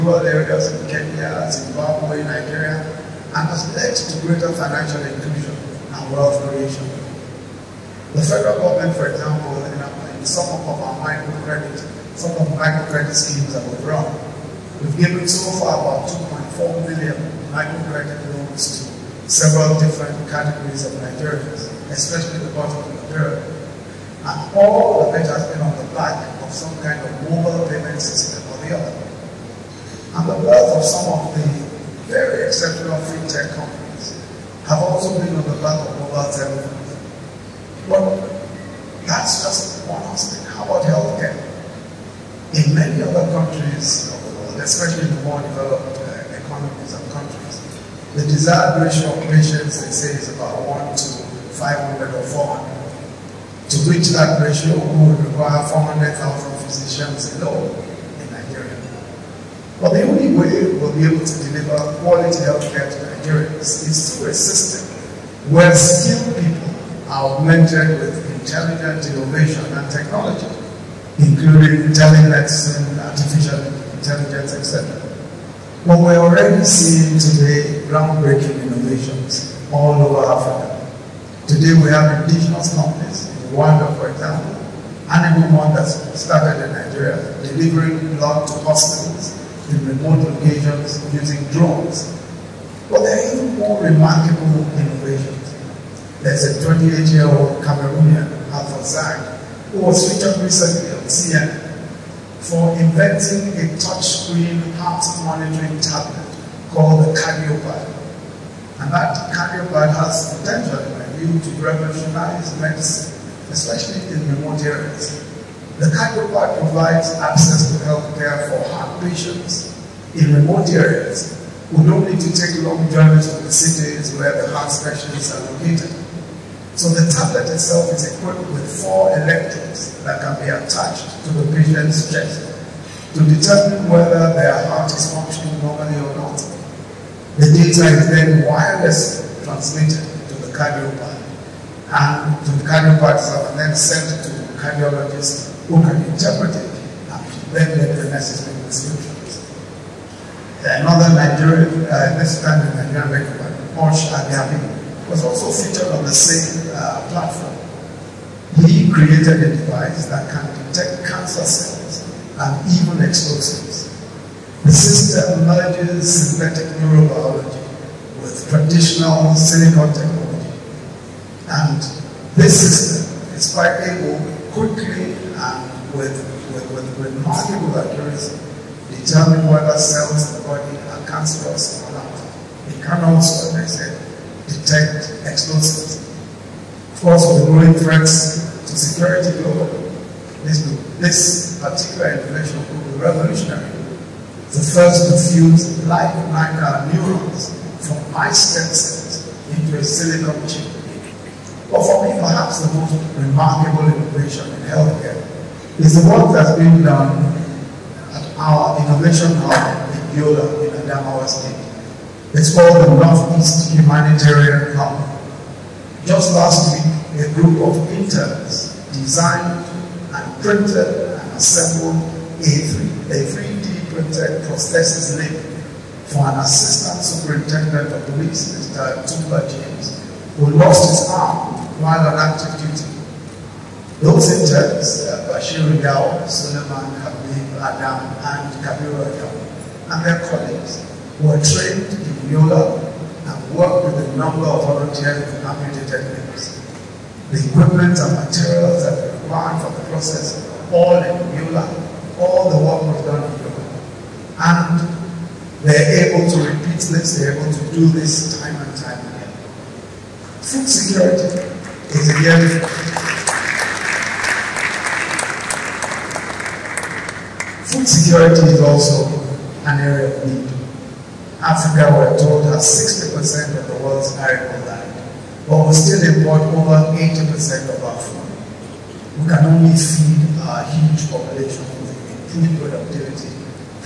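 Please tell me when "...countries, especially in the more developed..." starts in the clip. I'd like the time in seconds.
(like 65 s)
43 s.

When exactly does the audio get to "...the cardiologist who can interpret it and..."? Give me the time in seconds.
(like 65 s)
144 s.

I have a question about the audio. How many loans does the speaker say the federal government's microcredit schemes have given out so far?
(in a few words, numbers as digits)
2.4 million.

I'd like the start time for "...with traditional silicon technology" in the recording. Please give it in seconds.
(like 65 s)
168 s.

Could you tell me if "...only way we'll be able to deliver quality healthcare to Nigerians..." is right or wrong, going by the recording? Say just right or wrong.
right.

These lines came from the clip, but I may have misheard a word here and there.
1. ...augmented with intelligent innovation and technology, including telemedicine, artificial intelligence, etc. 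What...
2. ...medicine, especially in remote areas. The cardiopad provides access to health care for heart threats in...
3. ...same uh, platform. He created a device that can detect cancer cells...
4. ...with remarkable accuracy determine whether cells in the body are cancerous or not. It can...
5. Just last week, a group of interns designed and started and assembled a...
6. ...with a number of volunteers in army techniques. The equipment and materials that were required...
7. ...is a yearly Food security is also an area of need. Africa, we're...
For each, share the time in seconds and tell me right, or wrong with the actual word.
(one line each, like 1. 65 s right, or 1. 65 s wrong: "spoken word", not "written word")
1. 67 s right
2. 112 s wrong: "patients", not "threats"
3. 156 s right
4. 176 s right
5. 216 s wrong: "printed", not "started"
6. 243 s right
7. 261 s right.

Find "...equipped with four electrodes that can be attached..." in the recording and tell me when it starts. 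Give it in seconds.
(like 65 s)
128 s.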